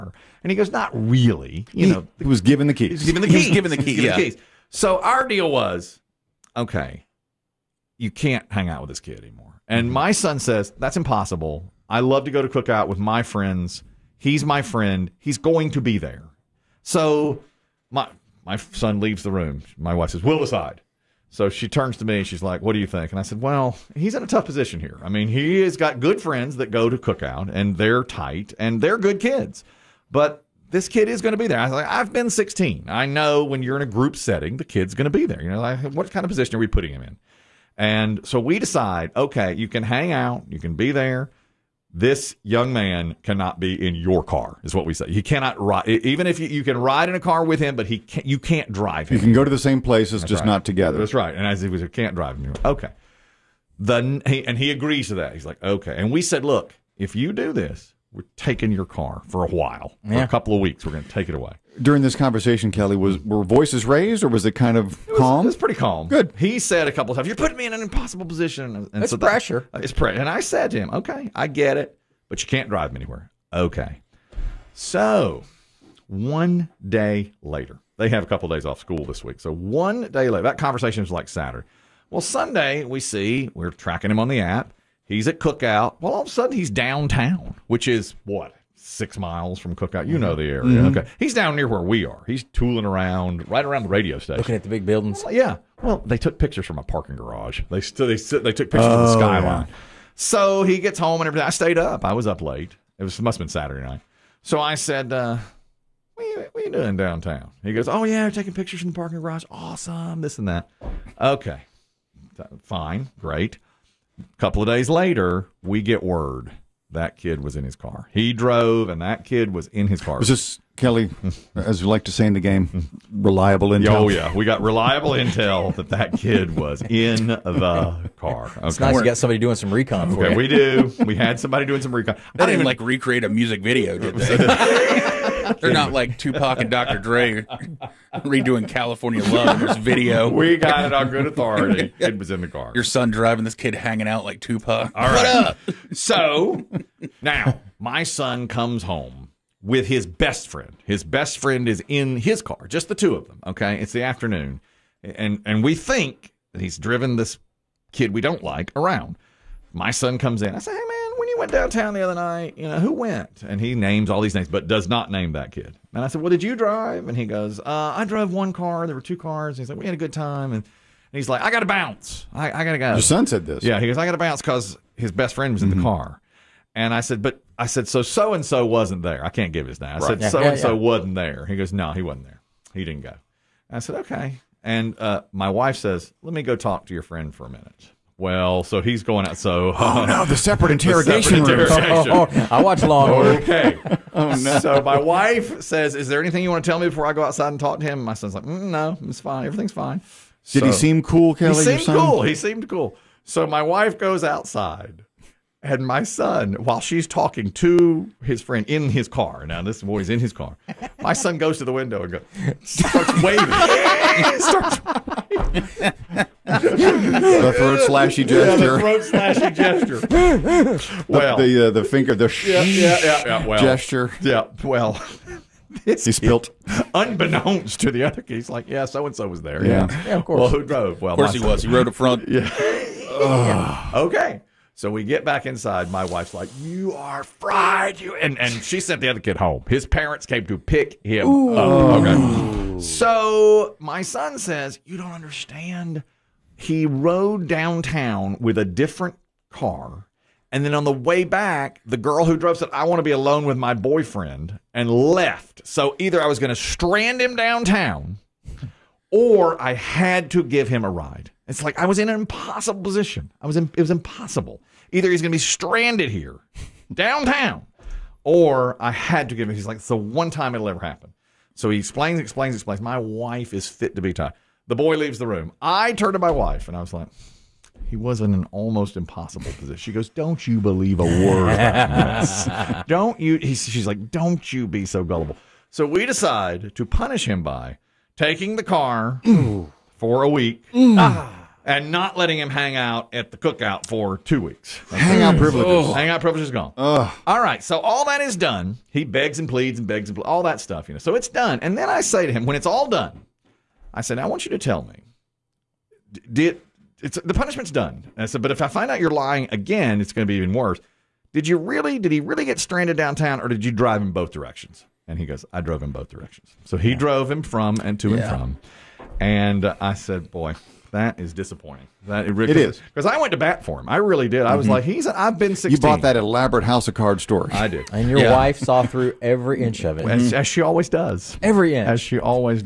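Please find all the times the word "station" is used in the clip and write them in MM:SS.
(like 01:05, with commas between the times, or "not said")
01:34.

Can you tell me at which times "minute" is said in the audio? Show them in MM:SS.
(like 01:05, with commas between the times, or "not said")
03:07.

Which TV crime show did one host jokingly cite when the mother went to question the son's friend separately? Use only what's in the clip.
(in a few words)
Law and Order.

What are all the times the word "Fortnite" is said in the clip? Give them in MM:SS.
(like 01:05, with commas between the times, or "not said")
not said.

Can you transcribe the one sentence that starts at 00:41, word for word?
This young man cannot be in your car, is what we say.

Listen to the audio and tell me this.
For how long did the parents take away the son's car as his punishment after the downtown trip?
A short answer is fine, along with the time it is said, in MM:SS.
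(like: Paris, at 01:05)
A week, at 04:50.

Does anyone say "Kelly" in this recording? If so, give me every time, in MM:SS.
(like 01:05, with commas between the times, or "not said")
01:02, 02:00, 03:21.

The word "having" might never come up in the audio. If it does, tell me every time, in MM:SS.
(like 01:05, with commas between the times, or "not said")
not said.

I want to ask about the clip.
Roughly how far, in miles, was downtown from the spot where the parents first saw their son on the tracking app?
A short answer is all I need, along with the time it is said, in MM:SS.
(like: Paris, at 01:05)
6, at 01:28.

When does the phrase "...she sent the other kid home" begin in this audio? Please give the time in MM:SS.
03:58.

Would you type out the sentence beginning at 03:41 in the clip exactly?
well, the the, uh, the finger, the sh- yeah, yeah, yeah, yeah, well, gesture.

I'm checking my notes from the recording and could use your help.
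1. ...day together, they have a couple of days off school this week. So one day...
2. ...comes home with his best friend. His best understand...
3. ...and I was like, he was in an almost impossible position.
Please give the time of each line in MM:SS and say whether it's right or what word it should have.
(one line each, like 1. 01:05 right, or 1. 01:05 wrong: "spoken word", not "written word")
1. 01:16 wrong: "later", not "together"
2. 02:28 wrong: "friend", not "understand"
3. 04:36 right.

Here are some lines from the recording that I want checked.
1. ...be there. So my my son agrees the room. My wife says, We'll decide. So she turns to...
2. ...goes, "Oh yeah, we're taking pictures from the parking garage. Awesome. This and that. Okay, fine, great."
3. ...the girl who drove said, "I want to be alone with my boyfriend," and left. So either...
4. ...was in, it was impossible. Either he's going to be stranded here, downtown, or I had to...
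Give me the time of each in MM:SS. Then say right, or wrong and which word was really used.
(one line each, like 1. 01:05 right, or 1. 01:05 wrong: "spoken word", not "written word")
1. 00:15 wrong: "leaves", not "agrees"
2. 01:47 right
3. 04:11 right
4. 04:23 right.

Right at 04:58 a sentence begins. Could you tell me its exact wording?
He begs and pleads and begs and pleads.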